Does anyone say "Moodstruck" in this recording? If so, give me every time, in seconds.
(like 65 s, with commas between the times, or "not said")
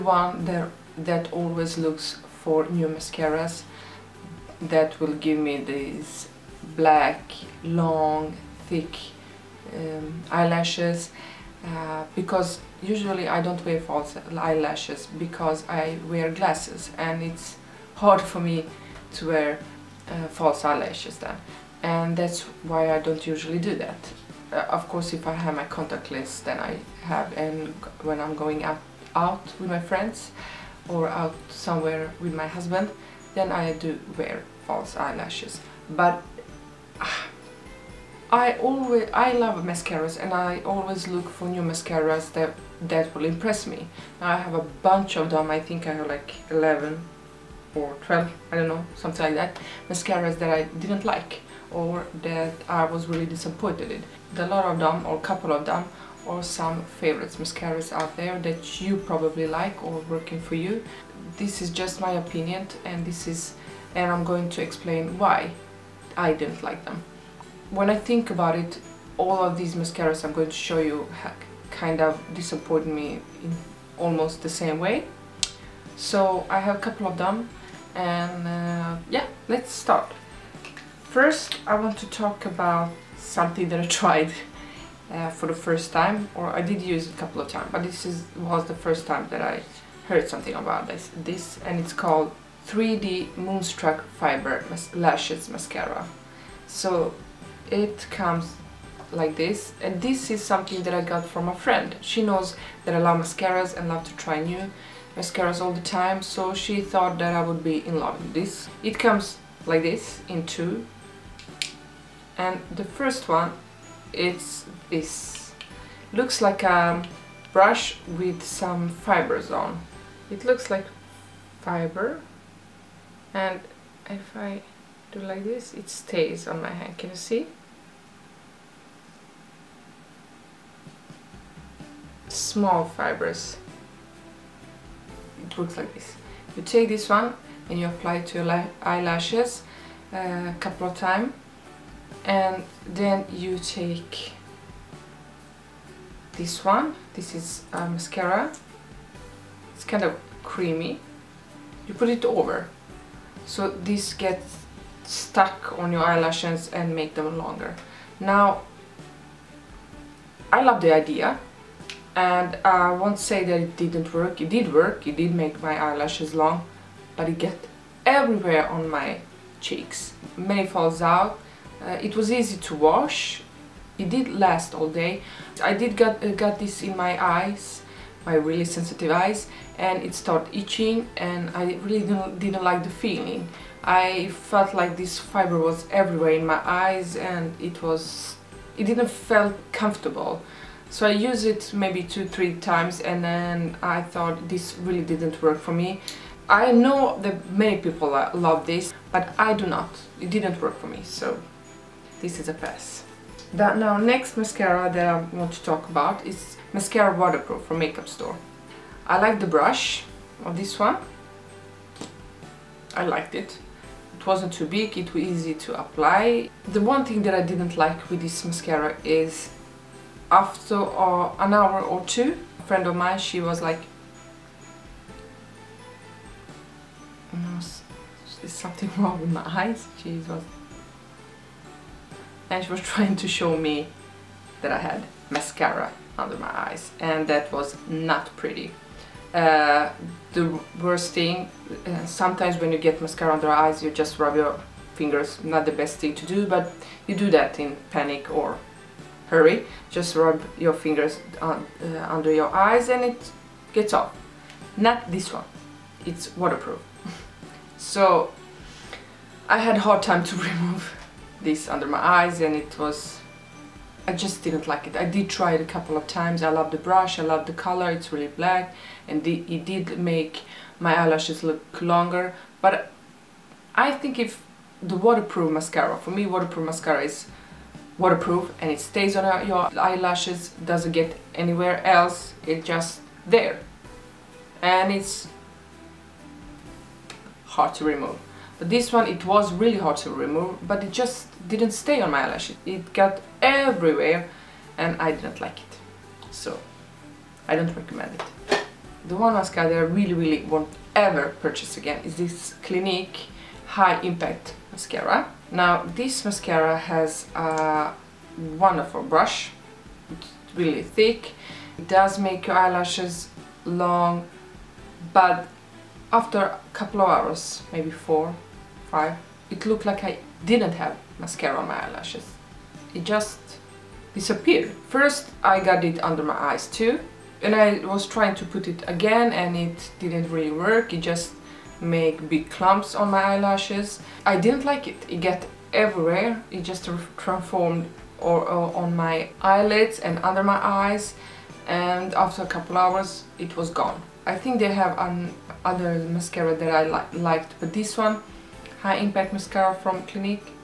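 93 s.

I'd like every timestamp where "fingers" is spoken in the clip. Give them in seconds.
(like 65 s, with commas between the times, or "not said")
244 s, 250 s.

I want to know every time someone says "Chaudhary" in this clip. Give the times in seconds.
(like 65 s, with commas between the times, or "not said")
not said.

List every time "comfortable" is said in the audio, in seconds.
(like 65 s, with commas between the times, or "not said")
189 s.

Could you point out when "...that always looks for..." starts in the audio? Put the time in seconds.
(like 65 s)
0 s.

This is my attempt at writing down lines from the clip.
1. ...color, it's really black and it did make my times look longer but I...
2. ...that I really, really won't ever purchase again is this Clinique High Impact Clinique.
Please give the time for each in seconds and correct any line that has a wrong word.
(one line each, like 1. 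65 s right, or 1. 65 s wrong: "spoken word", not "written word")
1. 267 s wrong: "eyelashes", not "times"
2. 299 s wrong: "Mascara", not "Clinique".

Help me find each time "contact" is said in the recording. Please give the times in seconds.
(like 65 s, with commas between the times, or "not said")
25 s.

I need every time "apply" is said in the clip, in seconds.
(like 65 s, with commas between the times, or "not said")
137 s, 215 s.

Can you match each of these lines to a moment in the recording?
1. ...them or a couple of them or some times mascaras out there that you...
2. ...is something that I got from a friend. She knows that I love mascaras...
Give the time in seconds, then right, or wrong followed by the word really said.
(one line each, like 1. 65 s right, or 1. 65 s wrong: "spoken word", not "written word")
1. 54 s wrong: "favorites", not "times"
2. 100 s right.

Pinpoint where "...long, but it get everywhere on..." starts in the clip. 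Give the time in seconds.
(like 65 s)
166 s.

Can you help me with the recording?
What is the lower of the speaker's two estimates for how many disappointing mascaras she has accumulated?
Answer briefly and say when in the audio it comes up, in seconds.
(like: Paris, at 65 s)
11, at 46 s.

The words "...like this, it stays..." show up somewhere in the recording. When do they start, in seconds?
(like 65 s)
125 s.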